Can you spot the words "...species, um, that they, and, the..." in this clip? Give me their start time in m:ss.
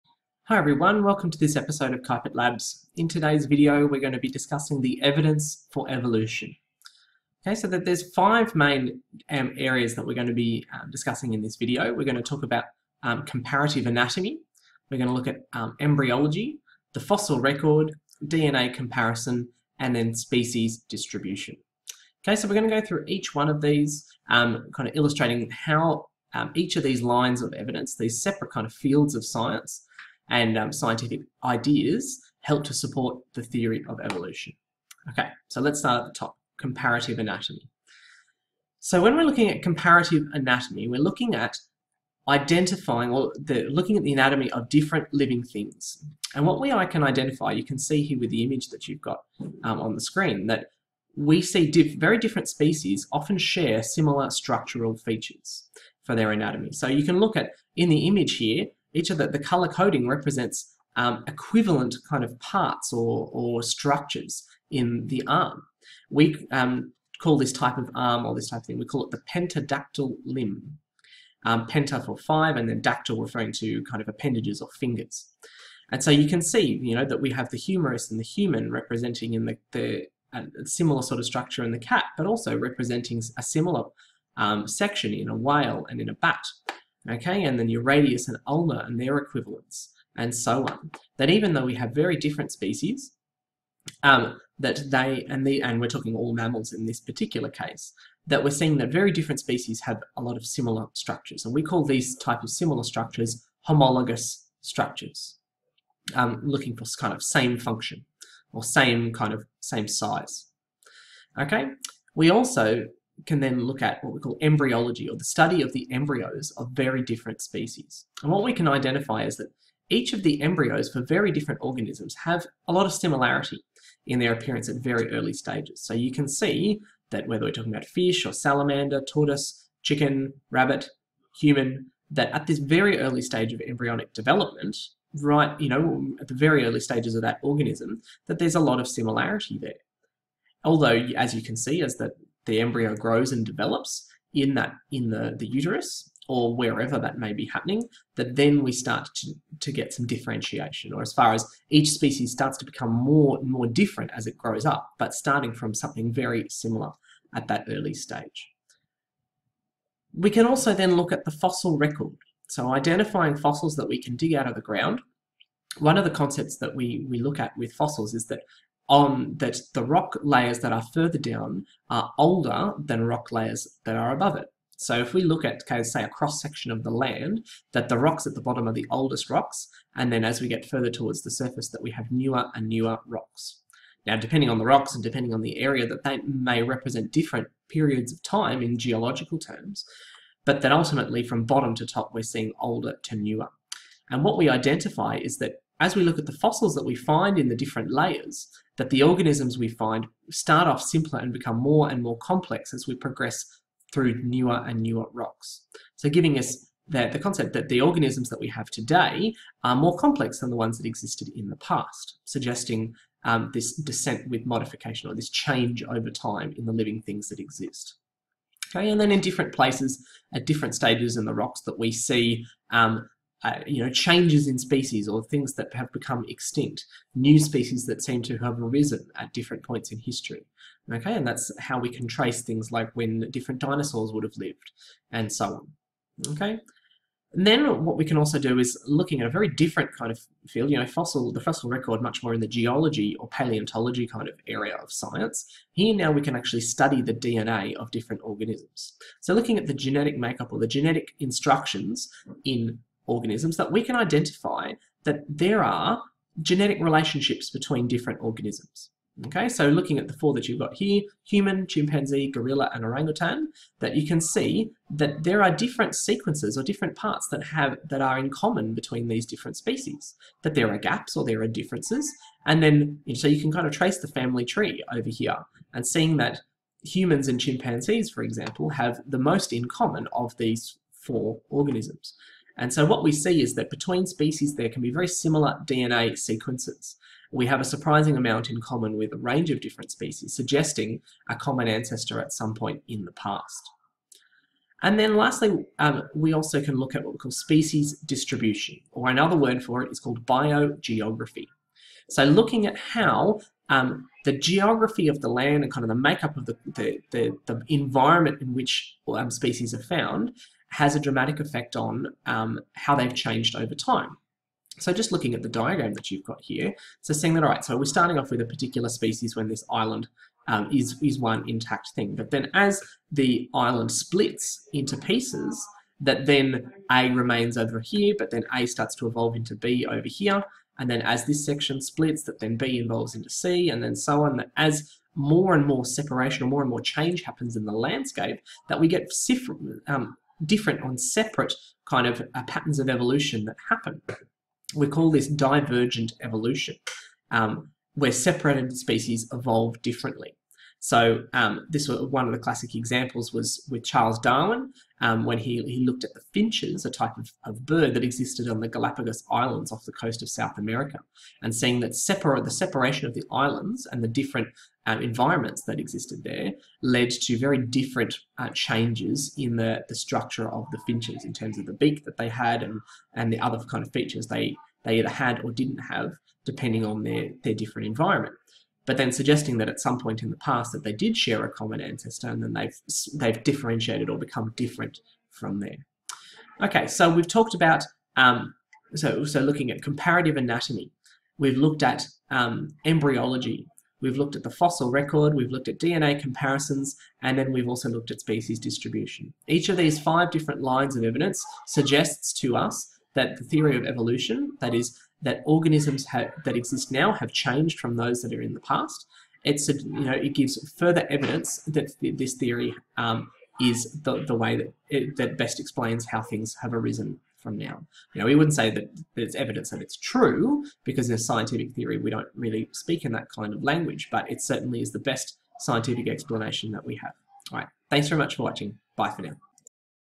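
1:32.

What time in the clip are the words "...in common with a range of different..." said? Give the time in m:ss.
4:48.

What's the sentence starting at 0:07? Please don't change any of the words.
Okay, so that there's five main um, areas that we're going to be um, discussing in this video.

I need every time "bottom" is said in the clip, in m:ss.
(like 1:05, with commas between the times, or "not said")
2:58, 3:11.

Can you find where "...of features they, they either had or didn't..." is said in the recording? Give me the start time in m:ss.
6:13.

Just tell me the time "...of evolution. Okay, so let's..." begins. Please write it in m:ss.
0:33.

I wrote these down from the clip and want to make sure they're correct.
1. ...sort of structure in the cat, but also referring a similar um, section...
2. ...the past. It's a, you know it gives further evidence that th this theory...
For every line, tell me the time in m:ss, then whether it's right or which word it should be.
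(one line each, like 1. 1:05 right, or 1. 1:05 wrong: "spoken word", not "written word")
1. 1:21 wrong: "representing", not "referring"
2. 6:48 right.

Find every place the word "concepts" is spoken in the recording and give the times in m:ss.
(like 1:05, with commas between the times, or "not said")
2:46, 3:27.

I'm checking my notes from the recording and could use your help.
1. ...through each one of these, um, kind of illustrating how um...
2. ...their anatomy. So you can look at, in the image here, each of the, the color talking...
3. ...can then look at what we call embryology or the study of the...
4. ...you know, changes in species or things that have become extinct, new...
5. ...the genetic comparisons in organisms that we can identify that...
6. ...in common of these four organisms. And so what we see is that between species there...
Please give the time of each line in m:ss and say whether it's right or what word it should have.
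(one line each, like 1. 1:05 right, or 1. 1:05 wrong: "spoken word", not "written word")
1. 0:22 right
2. 0:56 wrong: "coding", not "talking"
3. 1:53 right
4. 3:43 right
5. 4:10 wrong: "instructions", not "comparisons"
6. 4:39 right.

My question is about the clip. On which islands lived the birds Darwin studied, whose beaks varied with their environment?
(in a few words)
Galapagos Islands.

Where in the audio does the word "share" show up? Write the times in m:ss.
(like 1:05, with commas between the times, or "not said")
0:53, 6:21.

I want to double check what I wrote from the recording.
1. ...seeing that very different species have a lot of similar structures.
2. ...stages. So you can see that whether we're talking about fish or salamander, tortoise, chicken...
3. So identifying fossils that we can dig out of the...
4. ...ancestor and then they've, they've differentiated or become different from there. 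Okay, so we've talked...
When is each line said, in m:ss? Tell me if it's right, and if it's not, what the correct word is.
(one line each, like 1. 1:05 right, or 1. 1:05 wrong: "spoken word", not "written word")
1. 1:38 right
2. 2:05 right
3. 2:42 right
4. 6:21 right.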